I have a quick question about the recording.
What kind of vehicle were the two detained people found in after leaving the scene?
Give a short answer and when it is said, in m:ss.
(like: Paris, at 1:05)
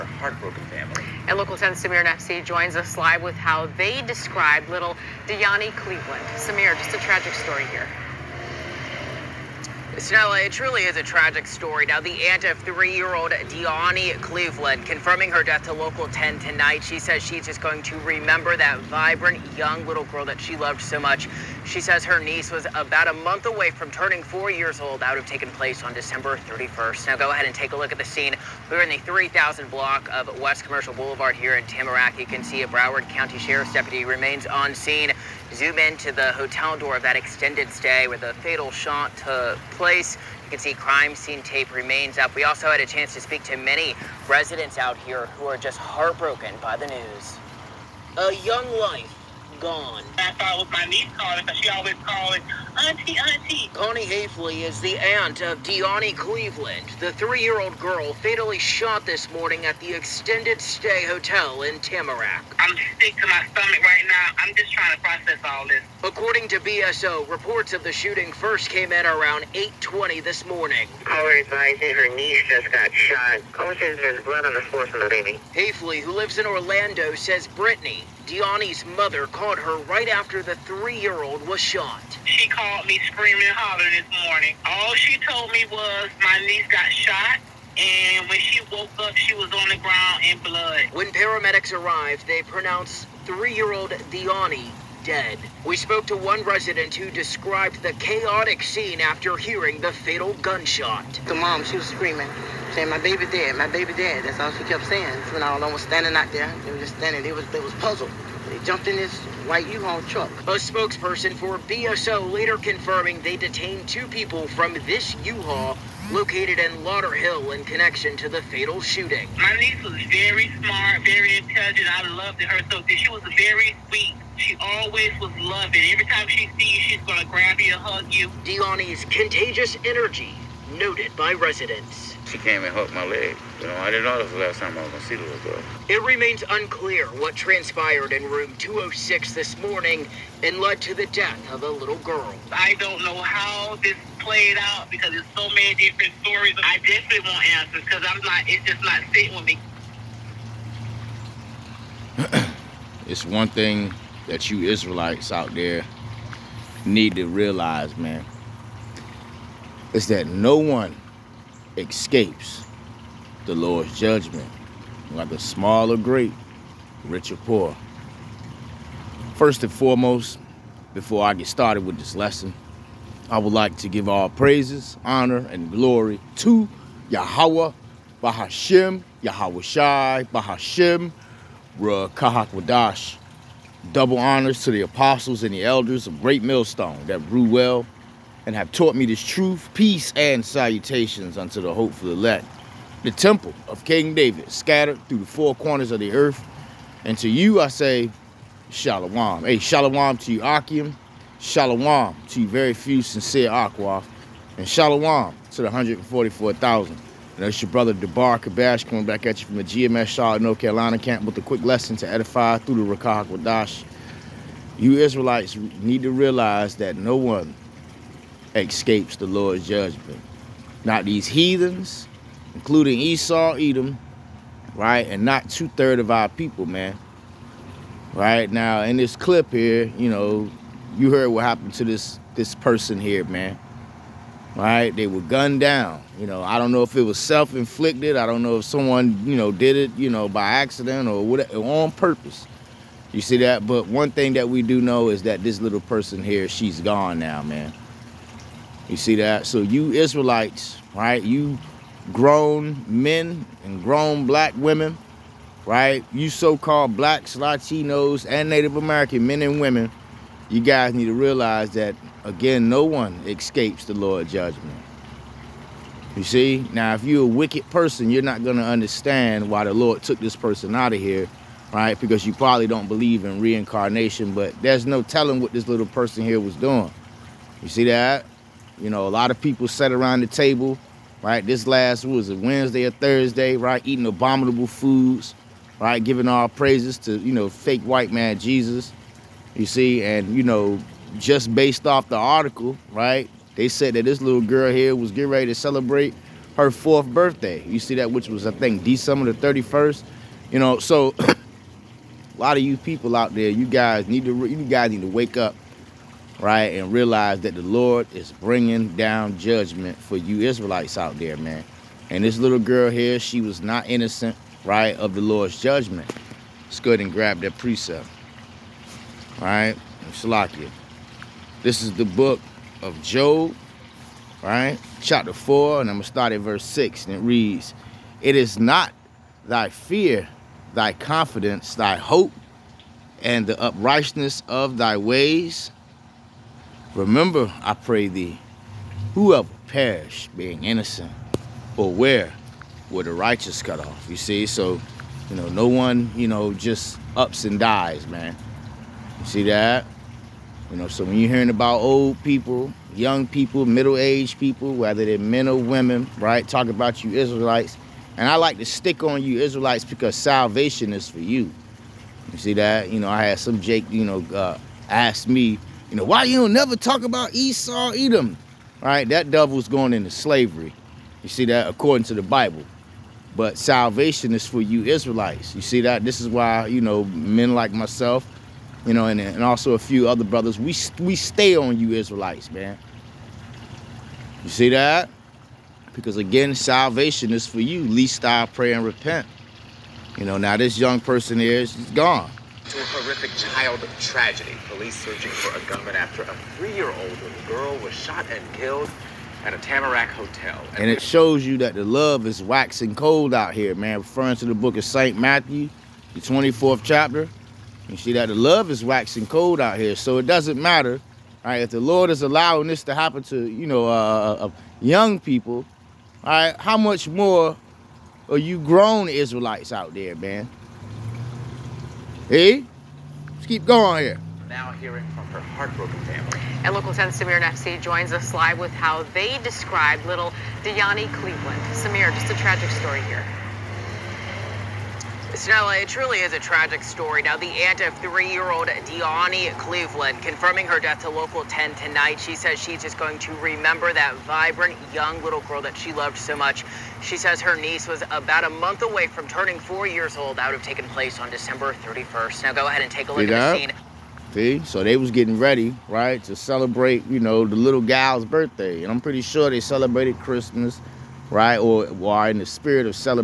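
White U-Haul truck, at 1:49.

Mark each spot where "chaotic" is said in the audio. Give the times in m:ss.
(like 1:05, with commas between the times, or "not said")
1:37.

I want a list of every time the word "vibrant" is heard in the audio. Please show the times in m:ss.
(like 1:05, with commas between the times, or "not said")
0:18, 7:24.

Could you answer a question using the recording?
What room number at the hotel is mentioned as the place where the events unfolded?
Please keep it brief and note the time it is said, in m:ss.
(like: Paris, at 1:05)
206, at 2:18.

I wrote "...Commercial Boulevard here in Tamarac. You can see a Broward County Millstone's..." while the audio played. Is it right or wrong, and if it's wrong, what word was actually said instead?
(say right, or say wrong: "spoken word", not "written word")
wrong: "Sheriff", not "Millstone".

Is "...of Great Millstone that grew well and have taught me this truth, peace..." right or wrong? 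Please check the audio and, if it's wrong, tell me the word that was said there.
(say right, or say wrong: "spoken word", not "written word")
right.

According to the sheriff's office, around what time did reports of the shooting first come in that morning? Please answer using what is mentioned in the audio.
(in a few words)
8:20.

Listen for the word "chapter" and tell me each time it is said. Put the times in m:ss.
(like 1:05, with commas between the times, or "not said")
5:25, 6:46.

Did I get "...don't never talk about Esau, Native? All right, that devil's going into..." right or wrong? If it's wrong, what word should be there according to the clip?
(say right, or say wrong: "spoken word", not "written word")
wrong: "Edom", not "Native".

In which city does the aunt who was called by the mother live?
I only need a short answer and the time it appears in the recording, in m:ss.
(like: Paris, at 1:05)
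Orlando, at 1:16.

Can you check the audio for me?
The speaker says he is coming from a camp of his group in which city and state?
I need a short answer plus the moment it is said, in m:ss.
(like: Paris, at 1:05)
Charlotte, North Carolina, at 3:30.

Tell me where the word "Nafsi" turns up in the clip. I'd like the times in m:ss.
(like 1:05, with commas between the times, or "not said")
0:02, 7:07.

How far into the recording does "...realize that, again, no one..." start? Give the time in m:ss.
4:21.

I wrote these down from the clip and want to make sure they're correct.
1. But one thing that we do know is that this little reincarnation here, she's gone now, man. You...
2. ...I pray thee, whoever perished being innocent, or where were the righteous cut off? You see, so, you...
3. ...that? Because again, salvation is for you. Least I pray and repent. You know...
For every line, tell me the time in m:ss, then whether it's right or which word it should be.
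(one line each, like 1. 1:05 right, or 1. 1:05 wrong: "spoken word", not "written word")
1. 4:03 wrong: "person", not "reincarnation"
2. 5:37 right
3. 6:24 right.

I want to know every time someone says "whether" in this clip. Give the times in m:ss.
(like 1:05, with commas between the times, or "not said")
2:45, 5:54.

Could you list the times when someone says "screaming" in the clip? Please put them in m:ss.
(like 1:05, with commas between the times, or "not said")
1:23, 1:41.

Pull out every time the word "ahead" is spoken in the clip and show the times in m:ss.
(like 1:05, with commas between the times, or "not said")
0:27, 5:16, 7:32.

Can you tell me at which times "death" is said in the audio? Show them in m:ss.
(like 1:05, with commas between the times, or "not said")
0:15, 2:21, 7:20.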